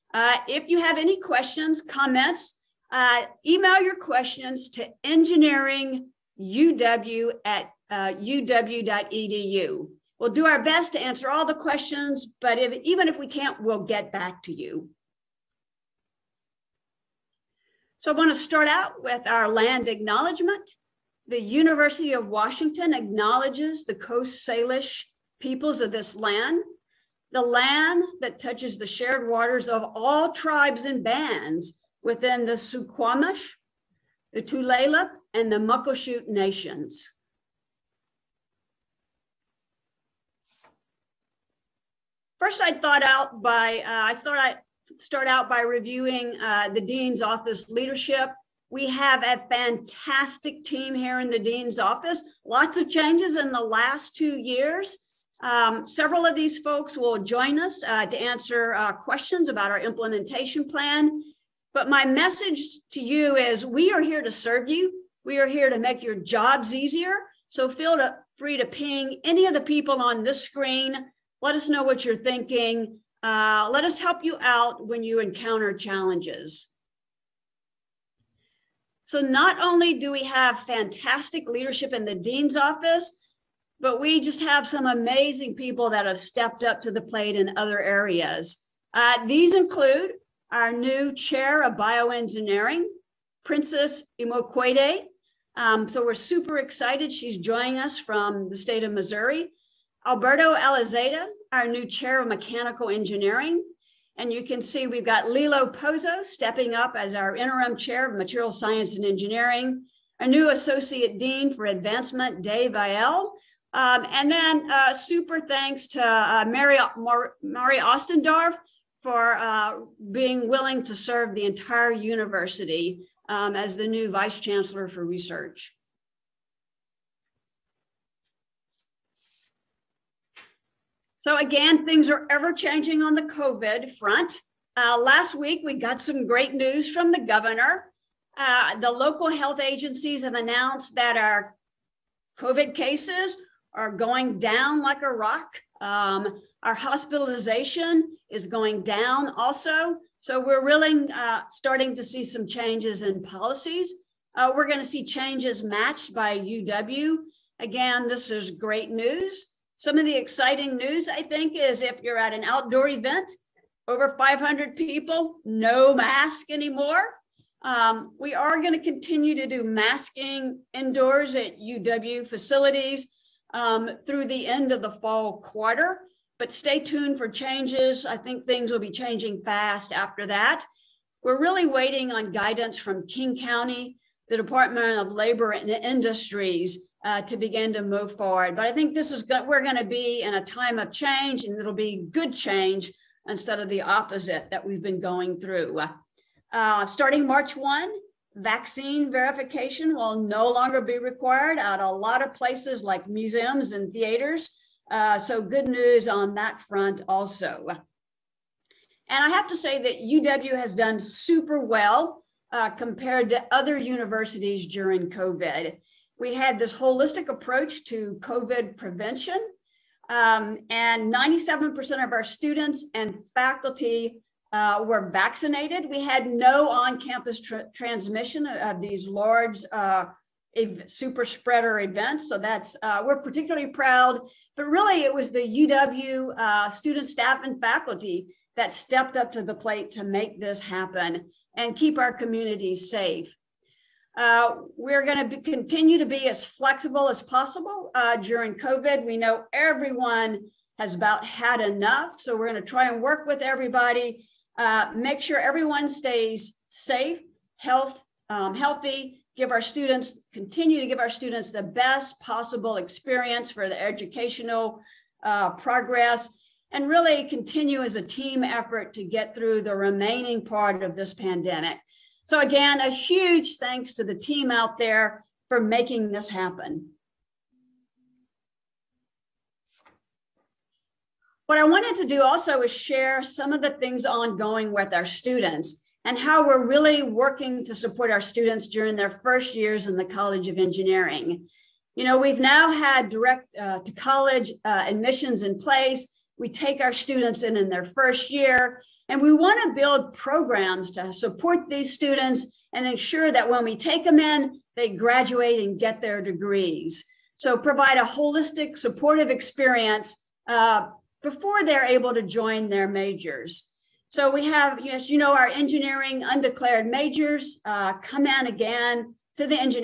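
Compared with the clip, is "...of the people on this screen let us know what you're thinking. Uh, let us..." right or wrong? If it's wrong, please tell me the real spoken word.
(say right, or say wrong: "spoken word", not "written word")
right.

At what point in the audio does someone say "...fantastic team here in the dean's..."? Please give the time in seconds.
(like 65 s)
49 s.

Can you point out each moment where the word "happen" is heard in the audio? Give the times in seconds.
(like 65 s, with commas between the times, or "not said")
240 s, 276 s.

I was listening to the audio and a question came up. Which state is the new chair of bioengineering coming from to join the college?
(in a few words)
Missouri.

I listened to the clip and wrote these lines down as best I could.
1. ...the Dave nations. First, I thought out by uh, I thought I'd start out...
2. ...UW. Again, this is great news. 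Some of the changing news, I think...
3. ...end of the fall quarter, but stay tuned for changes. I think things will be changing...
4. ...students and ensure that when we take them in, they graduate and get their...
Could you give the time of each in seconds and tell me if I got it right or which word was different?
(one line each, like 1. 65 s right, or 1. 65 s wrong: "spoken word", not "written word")
1. 35 s wrong: "Muckleshoot", not "Dave"
2. 156 s wrong: "exciting", not "changing"
3. 174 s right
4. 301 s right.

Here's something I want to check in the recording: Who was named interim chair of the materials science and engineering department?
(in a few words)
Lilo Pozzo.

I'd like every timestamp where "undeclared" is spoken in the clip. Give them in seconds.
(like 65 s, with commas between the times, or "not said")
316 s.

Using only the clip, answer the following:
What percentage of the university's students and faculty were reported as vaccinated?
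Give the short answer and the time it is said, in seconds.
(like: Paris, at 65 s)
97%, at 221 s.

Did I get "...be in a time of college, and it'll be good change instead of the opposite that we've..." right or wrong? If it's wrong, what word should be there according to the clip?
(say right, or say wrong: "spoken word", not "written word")
wrong: "change", not "college".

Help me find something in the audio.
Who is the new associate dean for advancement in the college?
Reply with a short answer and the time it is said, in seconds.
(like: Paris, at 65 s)
Dave Vail, at 112 s.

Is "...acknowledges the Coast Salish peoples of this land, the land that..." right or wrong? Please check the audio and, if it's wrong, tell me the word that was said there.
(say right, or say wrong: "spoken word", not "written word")
right.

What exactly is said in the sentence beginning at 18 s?
So I want to start out with our land acknowledgement.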